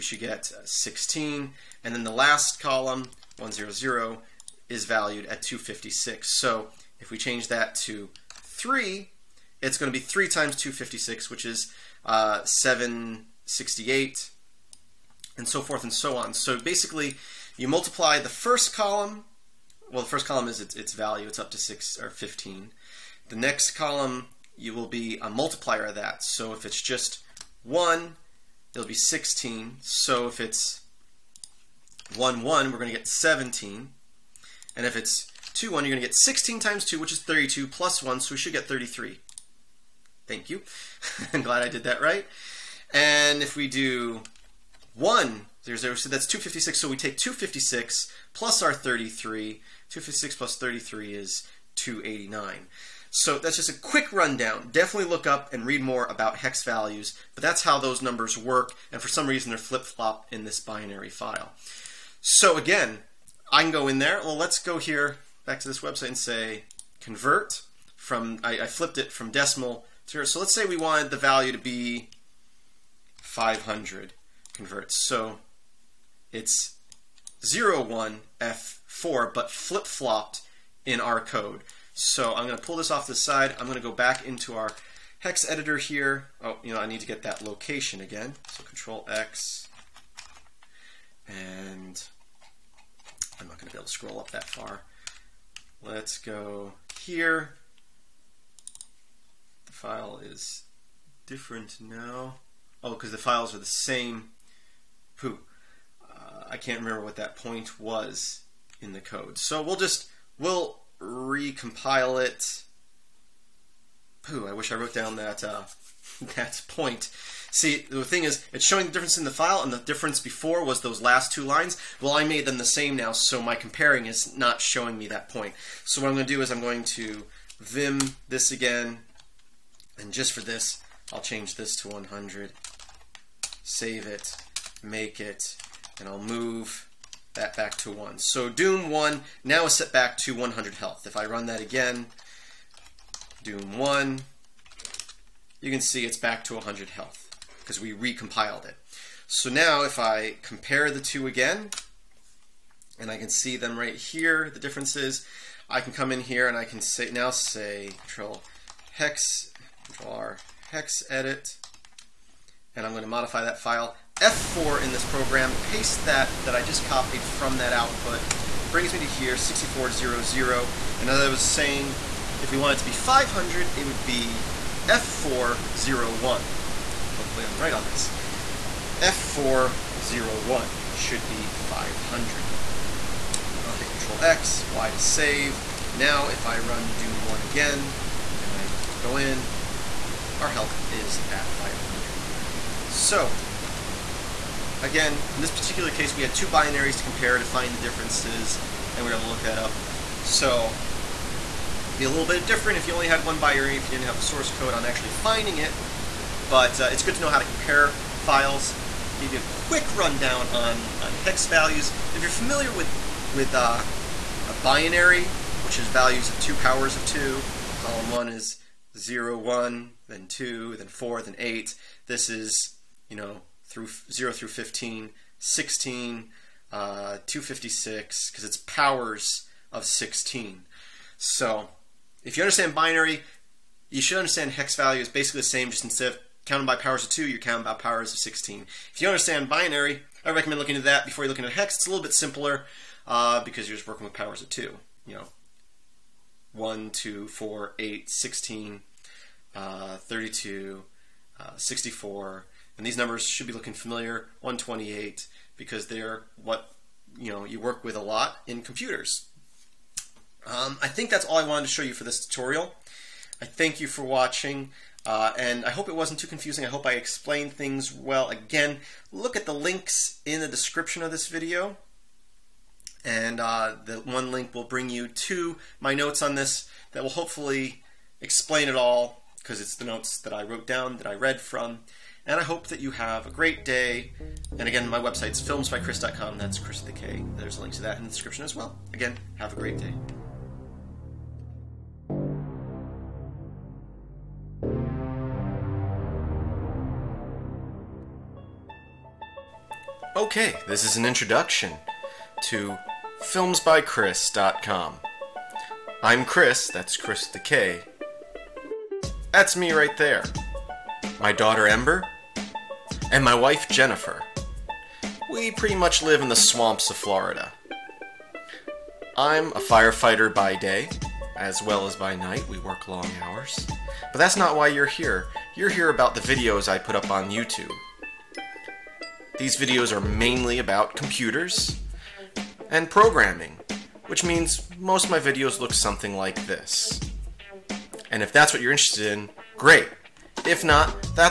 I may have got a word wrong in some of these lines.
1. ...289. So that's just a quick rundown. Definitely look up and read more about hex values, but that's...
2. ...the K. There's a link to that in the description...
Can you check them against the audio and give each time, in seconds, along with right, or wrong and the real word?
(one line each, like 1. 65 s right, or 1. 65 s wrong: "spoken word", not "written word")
1. 51 s right
2. 286 s right.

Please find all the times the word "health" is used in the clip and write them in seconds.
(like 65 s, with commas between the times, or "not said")
140 s, 146 s, 190 s.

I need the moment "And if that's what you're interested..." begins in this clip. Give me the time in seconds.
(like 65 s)
338 s.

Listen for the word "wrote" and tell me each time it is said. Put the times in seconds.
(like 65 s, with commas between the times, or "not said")
114 s, 280 s.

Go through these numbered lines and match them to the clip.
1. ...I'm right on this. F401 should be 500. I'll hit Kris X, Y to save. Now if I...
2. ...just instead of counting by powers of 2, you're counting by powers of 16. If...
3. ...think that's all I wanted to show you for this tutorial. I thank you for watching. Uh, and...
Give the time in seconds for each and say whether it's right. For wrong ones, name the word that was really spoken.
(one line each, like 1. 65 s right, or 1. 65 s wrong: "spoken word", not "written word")
1. 177 s wrong: "Control", not "Kris"
2. 235 s right
3. 260 s right.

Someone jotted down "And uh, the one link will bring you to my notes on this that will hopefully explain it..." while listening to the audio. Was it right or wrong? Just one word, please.
right.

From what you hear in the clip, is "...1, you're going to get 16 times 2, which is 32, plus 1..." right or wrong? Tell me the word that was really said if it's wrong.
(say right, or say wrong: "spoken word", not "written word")
right.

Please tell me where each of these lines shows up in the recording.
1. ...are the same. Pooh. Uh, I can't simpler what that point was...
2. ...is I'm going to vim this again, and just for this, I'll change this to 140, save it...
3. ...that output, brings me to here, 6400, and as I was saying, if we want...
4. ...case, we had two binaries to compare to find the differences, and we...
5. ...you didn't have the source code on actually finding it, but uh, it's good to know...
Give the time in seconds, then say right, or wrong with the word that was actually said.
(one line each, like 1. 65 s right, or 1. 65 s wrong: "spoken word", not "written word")
1. 103 s wrong: "remember", not "simpler"
2. 126 s wrong: "100", not "140"
3. 167 s right
4. 195 s right
5. 203 s right.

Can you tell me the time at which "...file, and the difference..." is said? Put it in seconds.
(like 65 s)
119 s.